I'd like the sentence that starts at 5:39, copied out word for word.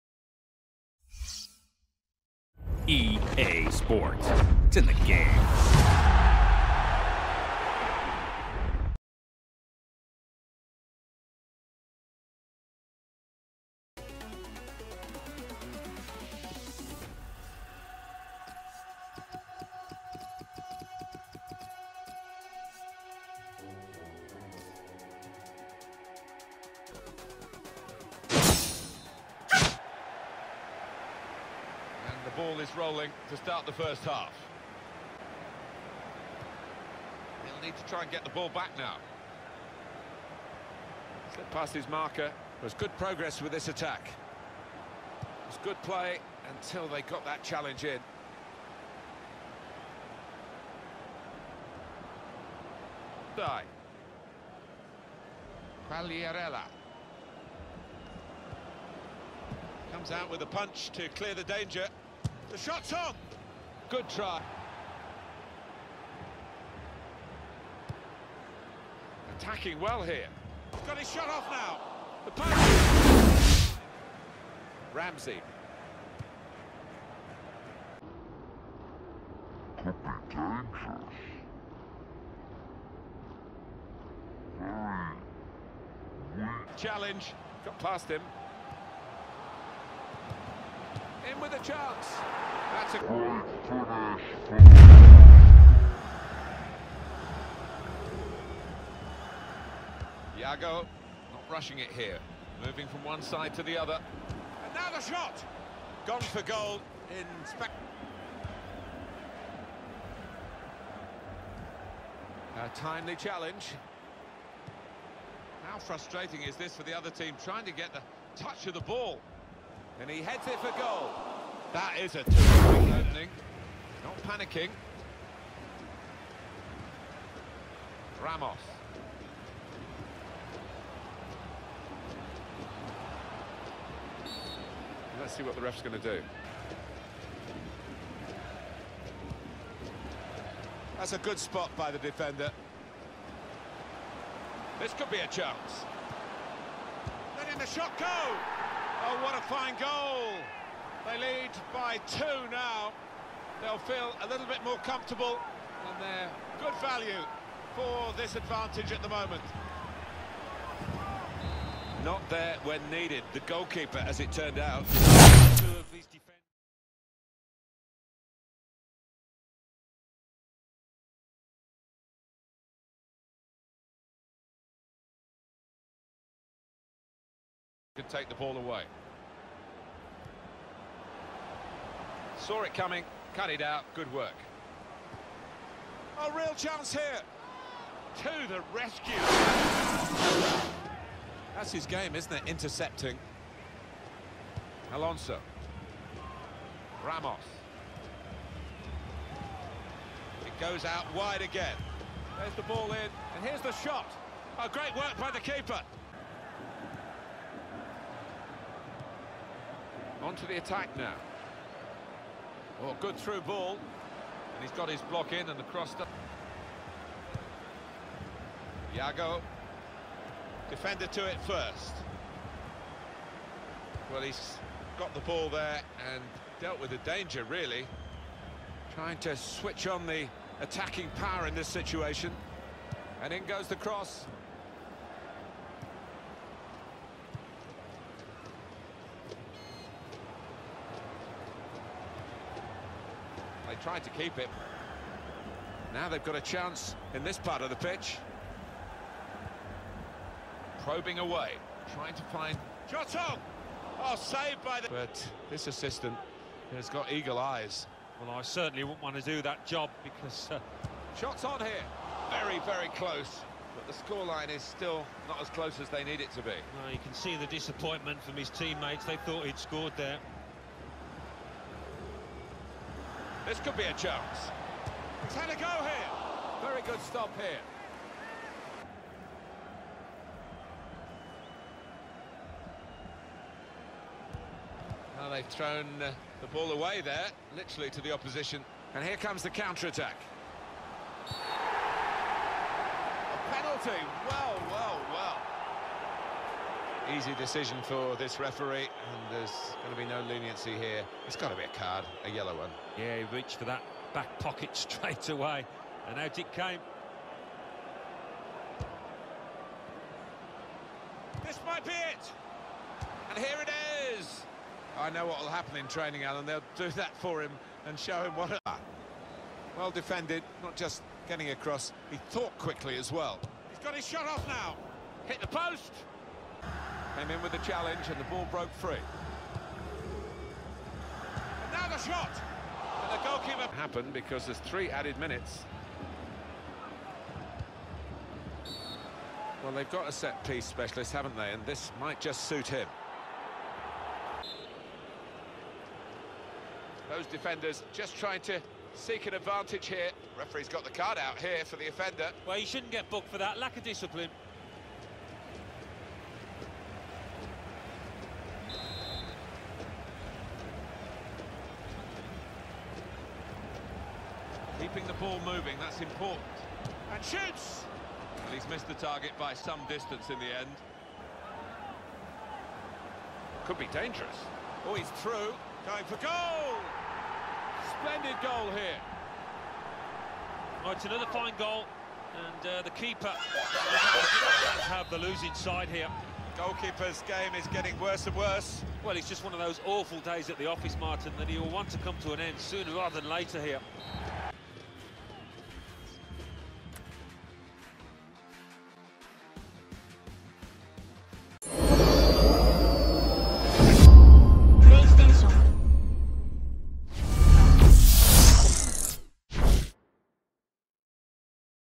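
Well, they've got a set-piece specialist, haven't they?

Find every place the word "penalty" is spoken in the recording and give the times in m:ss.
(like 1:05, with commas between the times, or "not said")
4:53.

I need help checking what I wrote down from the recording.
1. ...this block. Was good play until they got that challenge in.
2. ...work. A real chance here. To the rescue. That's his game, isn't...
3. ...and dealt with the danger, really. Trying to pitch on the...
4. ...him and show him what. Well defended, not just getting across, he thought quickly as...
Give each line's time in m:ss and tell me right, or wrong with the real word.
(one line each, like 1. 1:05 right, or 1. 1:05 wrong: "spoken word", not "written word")
1. 0:43 wrong: "attack", not "block"
2. 3:04 right
3. 3:46 wrong: "switch", not "pitch"
4. 5:17 right.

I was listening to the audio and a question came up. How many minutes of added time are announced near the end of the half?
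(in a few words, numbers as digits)
3.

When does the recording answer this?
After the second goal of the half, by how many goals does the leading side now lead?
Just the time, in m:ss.
2:32.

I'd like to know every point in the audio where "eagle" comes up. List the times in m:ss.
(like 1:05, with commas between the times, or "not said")
4:17.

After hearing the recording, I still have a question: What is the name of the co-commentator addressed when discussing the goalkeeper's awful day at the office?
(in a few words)
Martin.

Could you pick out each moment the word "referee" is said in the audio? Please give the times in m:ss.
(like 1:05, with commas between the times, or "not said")
4:58, 5:50.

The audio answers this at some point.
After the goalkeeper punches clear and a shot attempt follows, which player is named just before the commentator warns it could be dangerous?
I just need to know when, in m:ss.
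1:14.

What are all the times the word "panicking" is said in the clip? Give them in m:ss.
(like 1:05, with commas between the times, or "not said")
2:04.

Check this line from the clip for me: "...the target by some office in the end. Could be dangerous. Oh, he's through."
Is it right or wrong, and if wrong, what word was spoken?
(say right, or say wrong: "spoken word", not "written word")
wrong: "distance", not "office".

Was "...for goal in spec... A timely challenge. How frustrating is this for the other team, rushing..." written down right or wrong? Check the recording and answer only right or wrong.
wrong.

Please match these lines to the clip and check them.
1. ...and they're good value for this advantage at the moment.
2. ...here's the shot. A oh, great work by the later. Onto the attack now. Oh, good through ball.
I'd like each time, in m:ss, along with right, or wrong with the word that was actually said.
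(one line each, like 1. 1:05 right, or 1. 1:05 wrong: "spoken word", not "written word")
1. 2:35 right
2. 3:23 wrong: "keeper", not "later".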